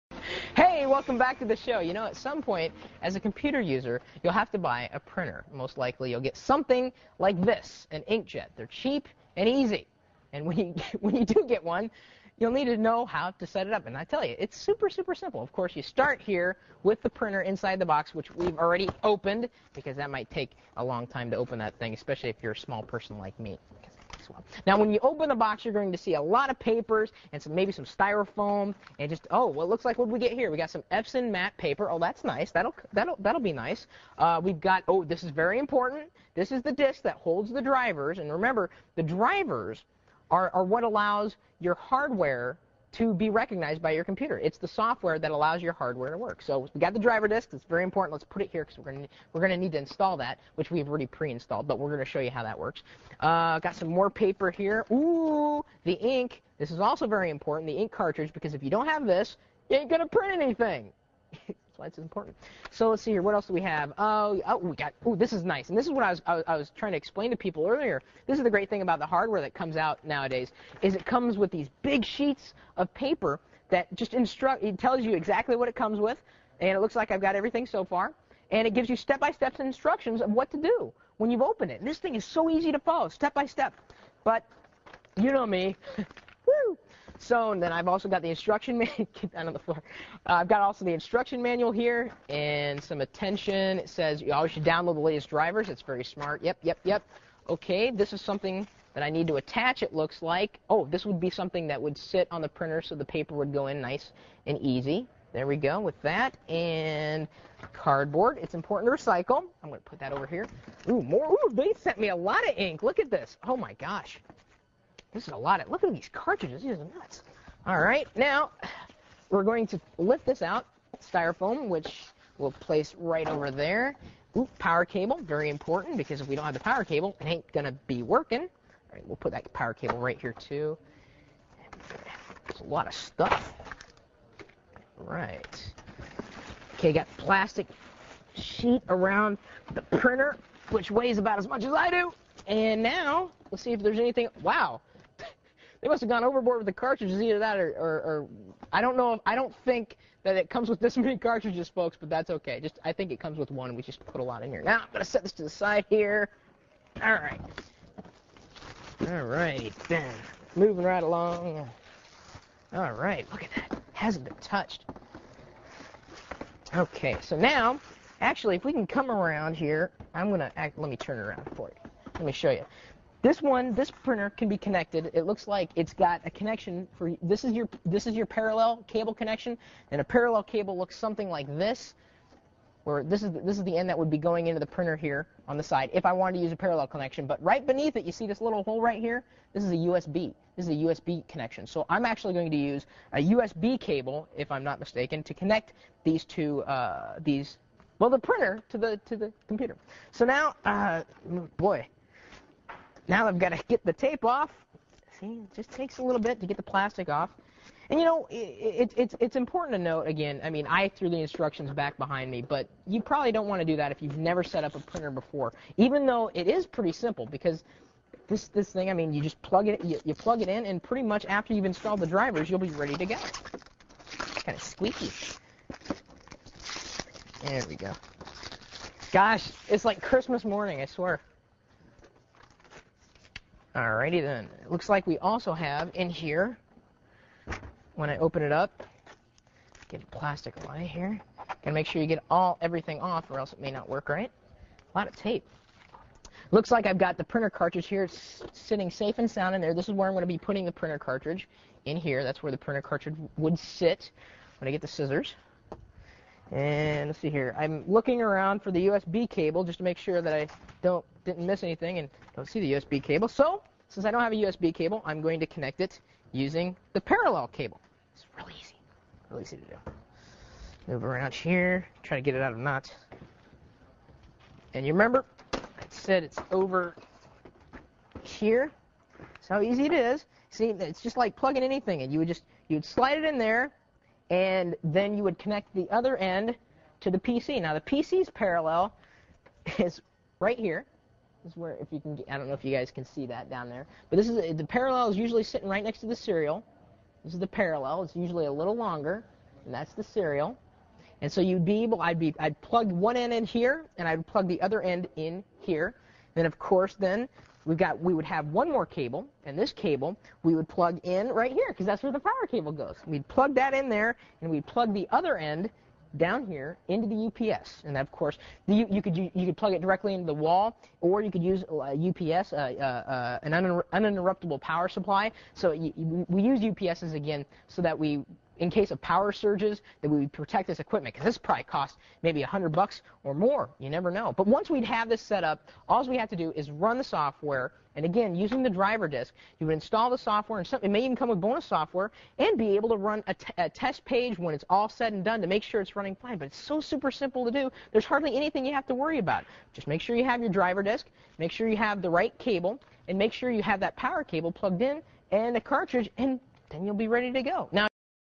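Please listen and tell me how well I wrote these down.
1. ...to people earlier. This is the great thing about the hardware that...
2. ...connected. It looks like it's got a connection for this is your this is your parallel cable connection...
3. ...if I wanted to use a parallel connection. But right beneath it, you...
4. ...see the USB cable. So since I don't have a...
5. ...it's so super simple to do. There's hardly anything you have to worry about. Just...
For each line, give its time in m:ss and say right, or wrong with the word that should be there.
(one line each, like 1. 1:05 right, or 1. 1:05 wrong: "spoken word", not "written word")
1. 1:07 right
2. 2:54 right
3. 3:05 right
4. 4:22 right
5. 5:46 right.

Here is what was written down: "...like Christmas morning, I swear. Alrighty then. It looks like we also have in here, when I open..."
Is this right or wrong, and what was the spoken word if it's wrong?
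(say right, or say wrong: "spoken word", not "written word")
right.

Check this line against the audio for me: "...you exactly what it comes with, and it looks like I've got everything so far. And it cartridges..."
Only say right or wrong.
wrong.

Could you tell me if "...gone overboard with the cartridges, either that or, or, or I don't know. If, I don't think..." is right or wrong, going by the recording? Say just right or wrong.
right.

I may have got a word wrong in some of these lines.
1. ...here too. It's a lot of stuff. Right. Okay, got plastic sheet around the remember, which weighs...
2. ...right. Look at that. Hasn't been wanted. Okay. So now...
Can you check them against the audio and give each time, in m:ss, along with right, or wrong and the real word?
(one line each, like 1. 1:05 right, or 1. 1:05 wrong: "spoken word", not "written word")
1. 2:10 wrong: "printer", not "remember"
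2. 2:42 wrong: "touched", not "wanted".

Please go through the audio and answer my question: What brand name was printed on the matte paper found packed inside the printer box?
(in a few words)
Epson.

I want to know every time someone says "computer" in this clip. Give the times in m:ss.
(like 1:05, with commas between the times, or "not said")
0:03, 0:44, 3:19.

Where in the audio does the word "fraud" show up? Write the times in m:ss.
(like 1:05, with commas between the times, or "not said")
not said.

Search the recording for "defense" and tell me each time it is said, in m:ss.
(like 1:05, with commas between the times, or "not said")
not said.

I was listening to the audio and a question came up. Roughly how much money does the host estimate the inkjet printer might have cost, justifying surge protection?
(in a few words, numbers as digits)
$100.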